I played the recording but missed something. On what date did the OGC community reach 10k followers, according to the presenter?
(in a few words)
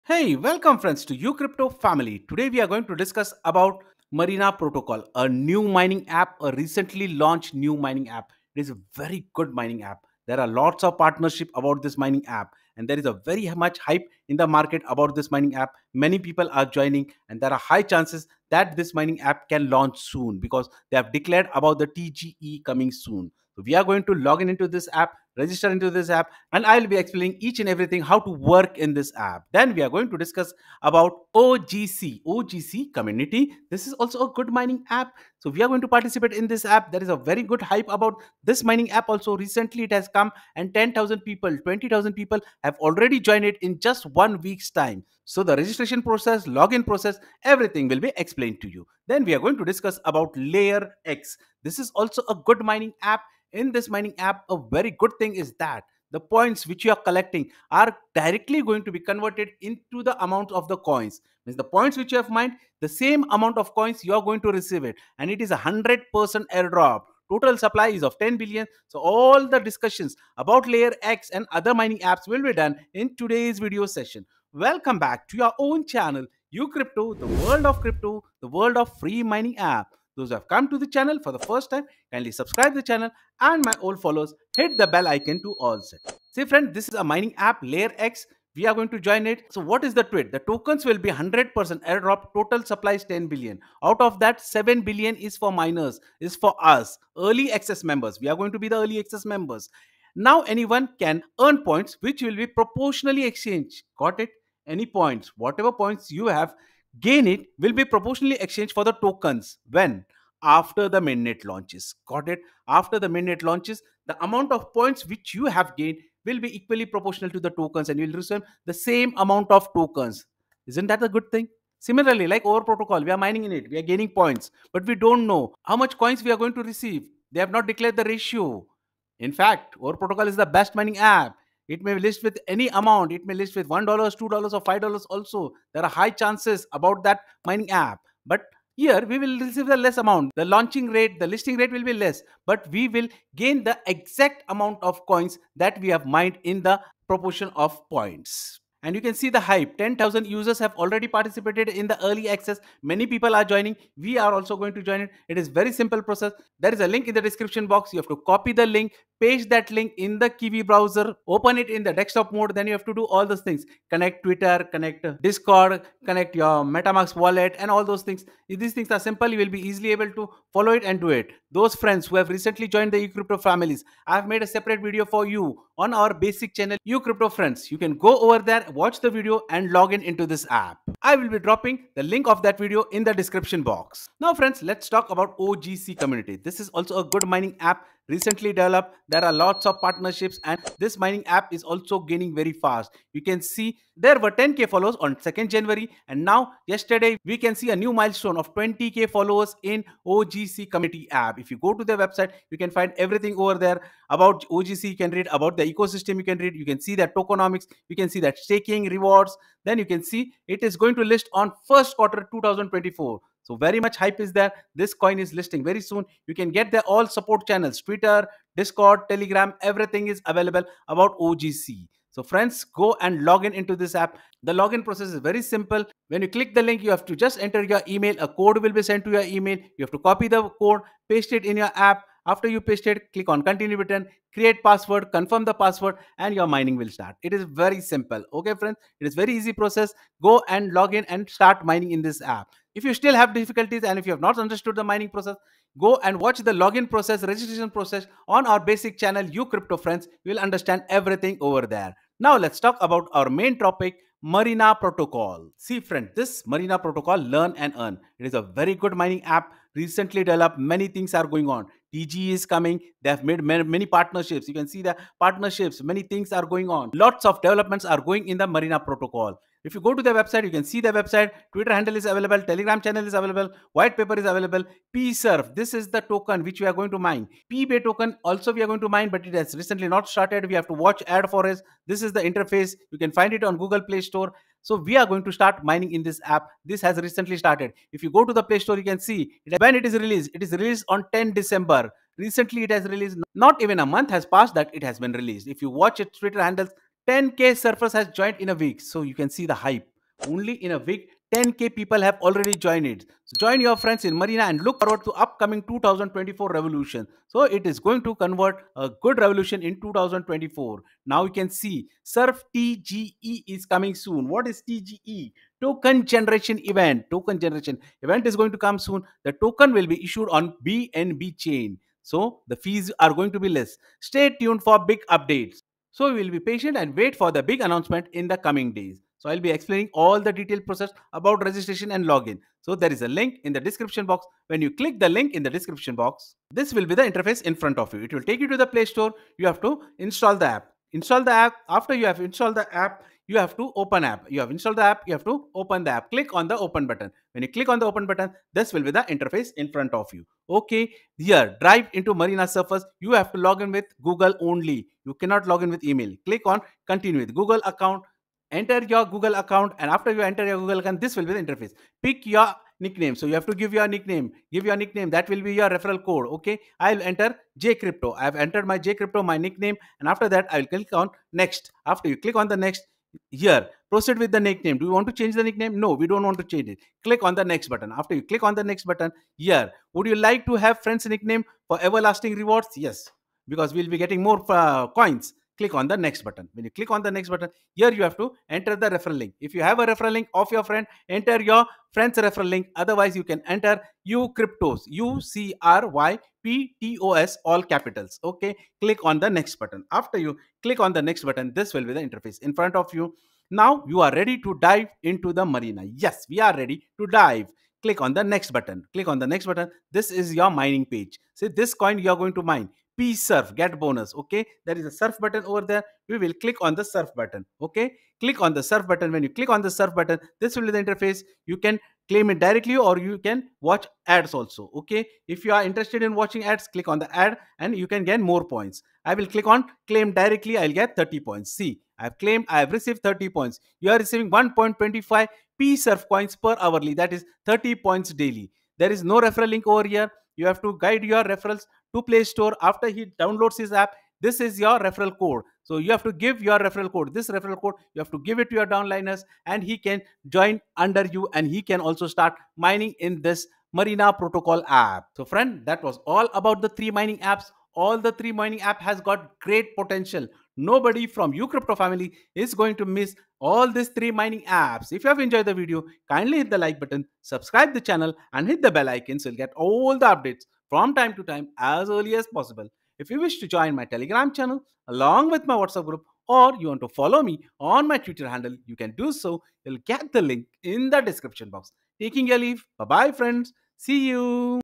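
2nd January.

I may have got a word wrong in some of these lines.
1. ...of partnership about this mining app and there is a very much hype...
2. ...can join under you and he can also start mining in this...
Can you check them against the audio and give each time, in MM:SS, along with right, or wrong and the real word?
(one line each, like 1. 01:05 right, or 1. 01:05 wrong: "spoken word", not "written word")
1. 00:10 right
2. 07:29 right.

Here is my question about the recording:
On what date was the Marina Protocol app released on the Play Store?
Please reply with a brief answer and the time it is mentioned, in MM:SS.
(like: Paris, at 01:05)
10 December, at 04:51.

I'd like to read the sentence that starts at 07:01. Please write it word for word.
You can claim it directly or you can watch ads also.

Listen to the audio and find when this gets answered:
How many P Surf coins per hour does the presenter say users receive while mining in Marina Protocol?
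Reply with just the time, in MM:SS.
07:14.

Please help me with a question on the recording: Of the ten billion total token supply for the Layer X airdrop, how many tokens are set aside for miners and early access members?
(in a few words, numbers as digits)
7 billion.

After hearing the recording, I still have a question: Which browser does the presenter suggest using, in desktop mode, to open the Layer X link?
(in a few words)
Kiwi browser.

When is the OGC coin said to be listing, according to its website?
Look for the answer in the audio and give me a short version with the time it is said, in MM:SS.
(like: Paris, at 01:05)
first quarter 2024, at 03:31.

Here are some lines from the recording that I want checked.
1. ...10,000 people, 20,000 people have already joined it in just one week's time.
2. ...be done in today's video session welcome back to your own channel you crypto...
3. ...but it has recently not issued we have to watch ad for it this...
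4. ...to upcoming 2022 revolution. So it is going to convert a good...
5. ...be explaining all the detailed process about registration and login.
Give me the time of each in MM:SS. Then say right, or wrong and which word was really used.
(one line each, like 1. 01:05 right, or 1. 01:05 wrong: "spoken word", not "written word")
1. 00:40 right
2. 01:12 right
3. 04:39 wrong: "started", not "issued"
4. 05:05 wrong: "2024", not "2022"
5. 05:29 right.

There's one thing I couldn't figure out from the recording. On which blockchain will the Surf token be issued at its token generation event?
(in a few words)
BNB chain.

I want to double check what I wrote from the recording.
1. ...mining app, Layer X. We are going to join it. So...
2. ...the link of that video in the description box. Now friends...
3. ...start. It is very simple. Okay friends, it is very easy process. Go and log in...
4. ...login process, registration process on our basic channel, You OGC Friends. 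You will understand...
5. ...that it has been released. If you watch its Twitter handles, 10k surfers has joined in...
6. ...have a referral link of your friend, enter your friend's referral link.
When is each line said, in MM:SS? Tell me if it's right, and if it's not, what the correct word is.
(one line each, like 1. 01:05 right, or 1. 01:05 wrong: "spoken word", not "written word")
1. 01:27 right
2. 03:01 right
3. 03:56 right
4. 04:06 wrong: "Crypto", not "OGC"
5. 04:54 right
6. 06:29 right.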